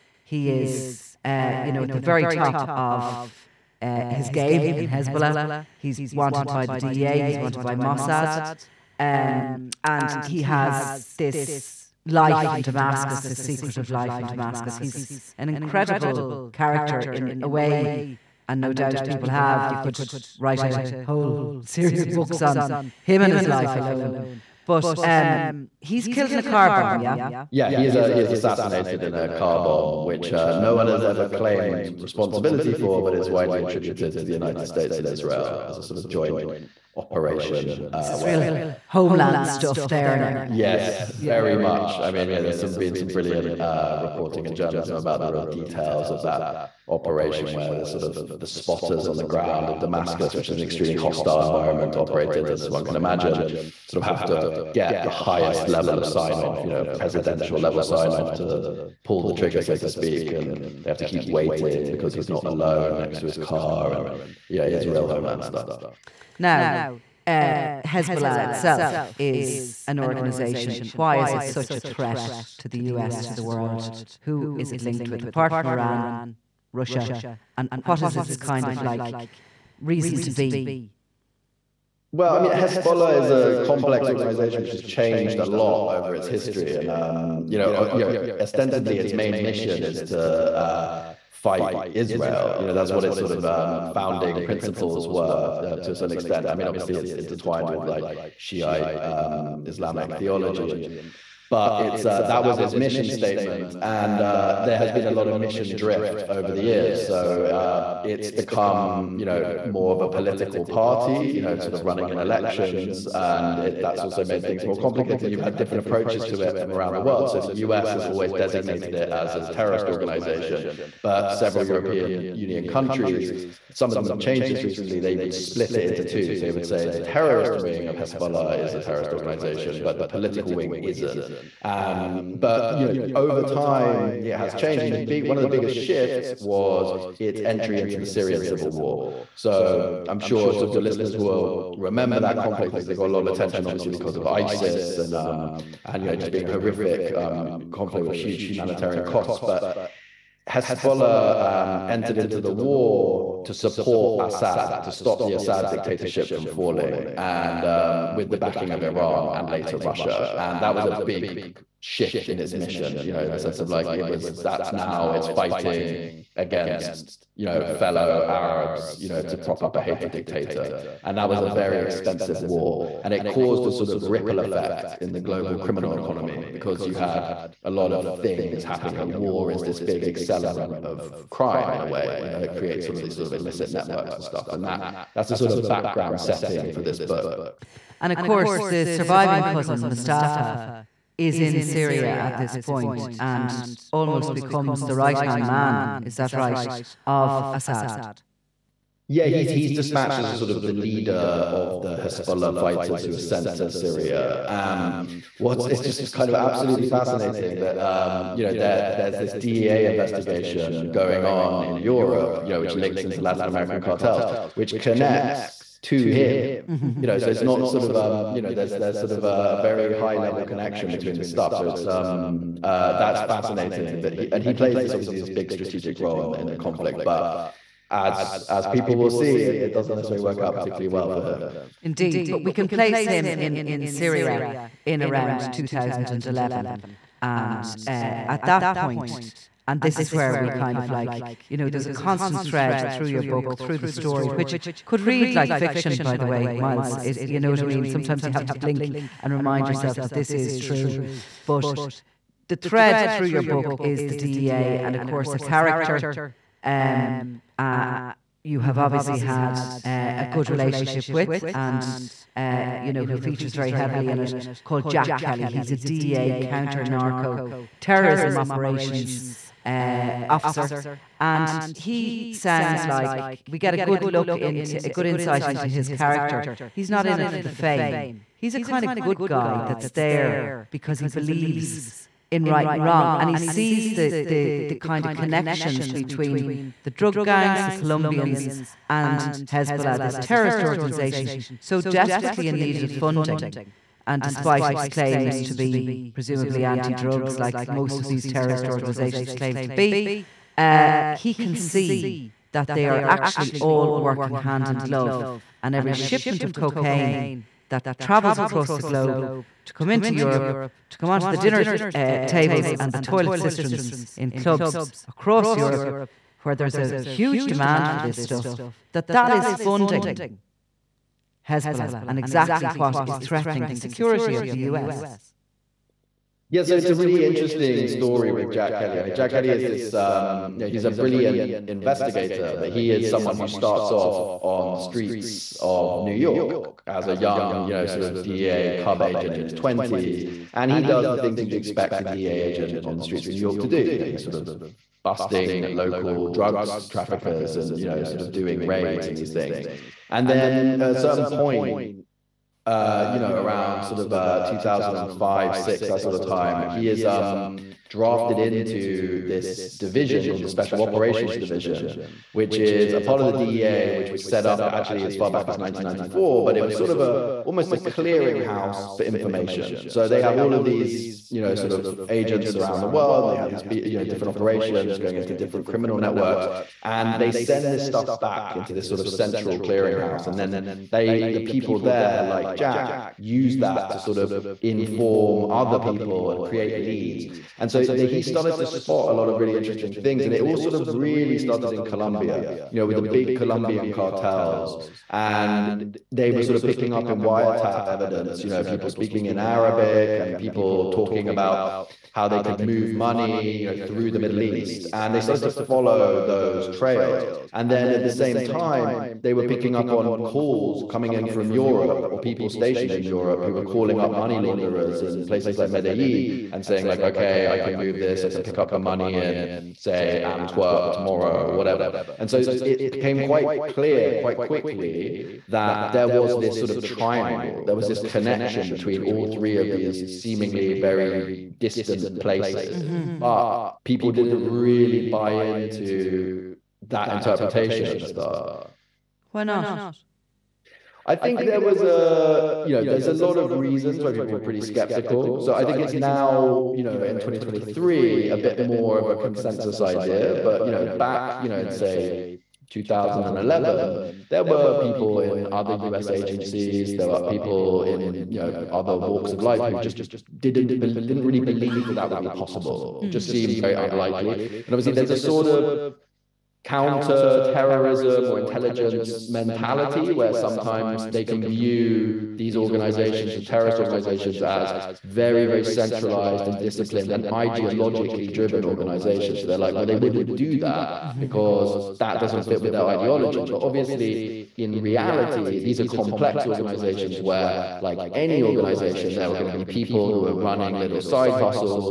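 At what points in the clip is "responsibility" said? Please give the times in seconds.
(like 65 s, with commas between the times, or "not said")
31 s.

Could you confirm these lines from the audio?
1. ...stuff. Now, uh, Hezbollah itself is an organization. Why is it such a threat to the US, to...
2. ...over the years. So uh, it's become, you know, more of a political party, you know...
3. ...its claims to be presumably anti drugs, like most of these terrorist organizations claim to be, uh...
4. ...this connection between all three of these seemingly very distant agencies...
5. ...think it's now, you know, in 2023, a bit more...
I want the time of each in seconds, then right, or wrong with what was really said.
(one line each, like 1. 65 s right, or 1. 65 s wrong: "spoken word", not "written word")
1. 65 s right
2. 106 s right
3. 294 s right
4. 427 s wrong: "places", not "agencies"
5. 445 s right.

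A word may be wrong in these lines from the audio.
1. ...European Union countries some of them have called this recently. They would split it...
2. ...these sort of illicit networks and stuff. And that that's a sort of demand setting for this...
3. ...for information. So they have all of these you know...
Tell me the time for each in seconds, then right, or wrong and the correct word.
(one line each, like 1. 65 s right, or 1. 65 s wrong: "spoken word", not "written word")
1. 121 s wrong: "changed", not "called"
2. 183 s wrong: "background", not "demand"
3. 368 s right.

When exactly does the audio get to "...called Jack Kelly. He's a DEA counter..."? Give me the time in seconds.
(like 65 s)
264 s.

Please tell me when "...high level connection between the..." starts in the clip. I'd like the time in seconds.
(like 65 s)
219 s.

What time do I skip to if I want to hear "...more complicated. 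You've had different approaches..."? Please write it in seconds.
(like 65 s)
114 s.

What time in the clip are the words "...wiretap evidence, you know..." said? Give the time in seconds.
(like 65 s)
397 s.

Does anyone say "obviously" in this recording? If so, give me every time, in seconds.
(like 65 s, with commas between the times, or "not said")
96 s, 143 s, 224 s, 258 s, 464 s, 483 s.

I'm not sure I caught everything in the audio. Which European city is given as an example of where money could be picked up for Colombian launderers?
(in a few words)
Antwerp.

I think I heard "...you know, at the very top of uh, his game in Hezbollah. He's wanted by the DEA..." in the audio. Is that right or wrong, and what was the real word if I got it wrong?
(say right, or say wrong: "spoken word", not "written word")
right.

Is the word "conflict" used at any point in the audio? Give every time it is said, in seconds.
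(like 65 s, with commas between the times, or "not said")
142 s, 147 s, 226 s.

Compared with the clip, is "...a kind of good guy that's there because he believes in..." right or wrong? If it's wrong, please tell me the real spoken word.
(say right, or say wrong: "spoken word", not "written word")
right.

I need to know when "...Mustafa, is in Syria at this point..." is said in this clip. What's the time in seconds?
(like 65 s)
189 s.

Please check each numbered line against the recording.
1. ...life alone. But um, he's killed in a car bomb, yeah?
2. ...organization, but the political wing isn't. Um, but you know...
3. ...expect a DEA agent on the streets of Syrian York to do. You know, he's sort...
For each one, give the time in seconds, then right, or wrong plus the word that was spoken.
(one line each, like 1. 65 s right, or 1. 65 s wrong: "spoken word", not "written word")
1. 23 s right
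2. 129 s right
3. 341 s wrong: "New", not "Syrian".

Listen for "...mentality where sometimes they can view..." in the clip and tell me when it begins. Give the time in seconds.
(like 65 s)
469 s.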